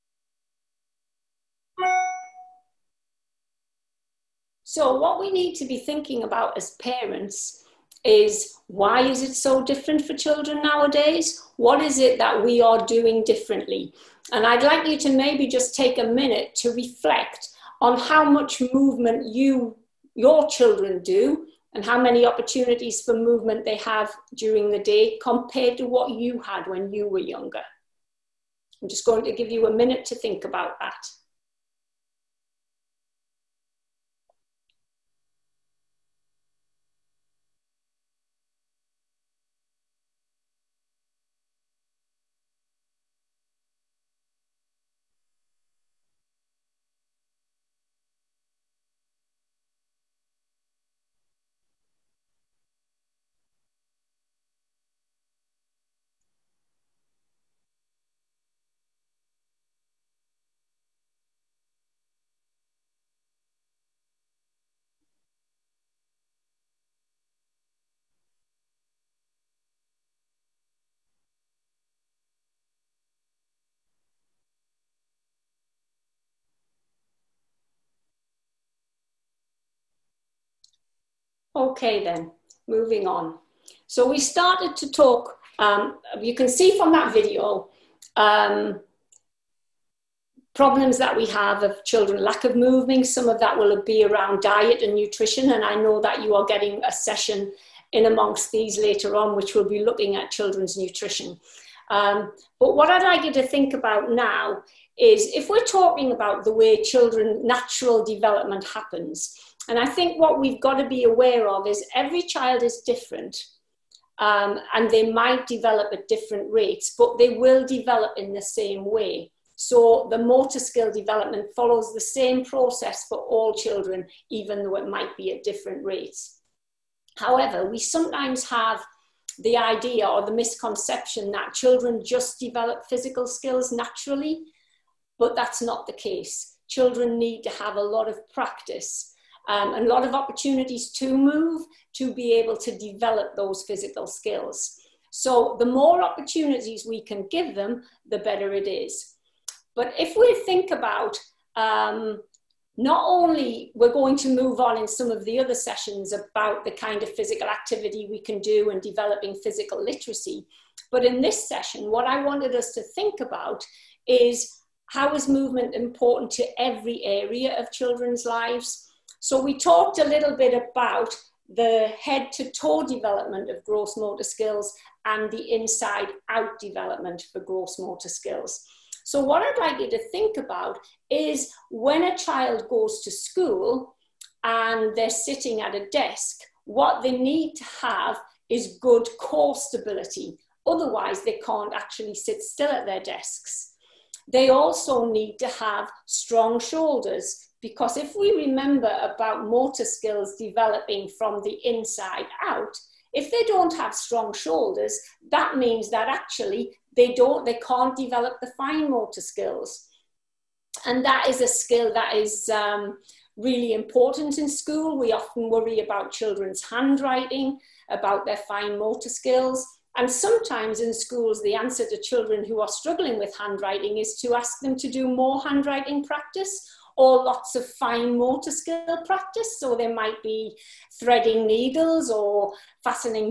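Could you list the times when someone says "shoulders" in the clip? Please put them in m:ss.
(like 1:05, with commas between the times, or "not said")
3:16, 3:24.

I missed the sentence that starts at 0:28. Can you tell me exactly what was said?
I'm just going to give you a minute to think about that.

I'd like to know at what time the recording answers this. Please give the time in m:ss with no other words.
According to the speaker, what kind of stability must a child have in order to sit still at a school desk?
3:09.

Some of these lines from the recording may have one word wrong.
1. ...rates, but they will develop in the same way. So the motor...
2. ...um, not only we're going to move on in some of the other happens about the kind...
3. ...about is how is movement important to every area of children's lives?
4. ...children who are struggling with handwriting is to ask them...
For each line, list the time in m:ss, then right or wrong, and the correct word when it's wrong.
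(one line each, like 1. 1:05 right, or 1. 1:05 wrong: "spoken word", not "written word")
1. 1:56 right
2. 2:31 wrong: "sessions", not "happens"
3. 2:43 right
4. 3:42 right.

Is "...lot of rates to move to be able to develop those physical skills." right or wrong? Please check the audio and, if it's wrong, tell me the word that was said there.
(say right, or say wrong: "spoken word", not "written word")
wrong: "opportunities", not "rates".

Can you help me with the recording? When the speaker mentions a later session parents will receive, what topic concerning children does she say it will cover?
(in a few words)
Children's nutrition.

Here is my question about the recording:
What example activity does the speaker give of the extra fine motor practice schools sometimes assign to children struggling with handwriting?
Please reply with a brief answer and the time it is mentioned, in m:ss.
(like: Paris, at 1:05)
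Threading needles, at 3:50.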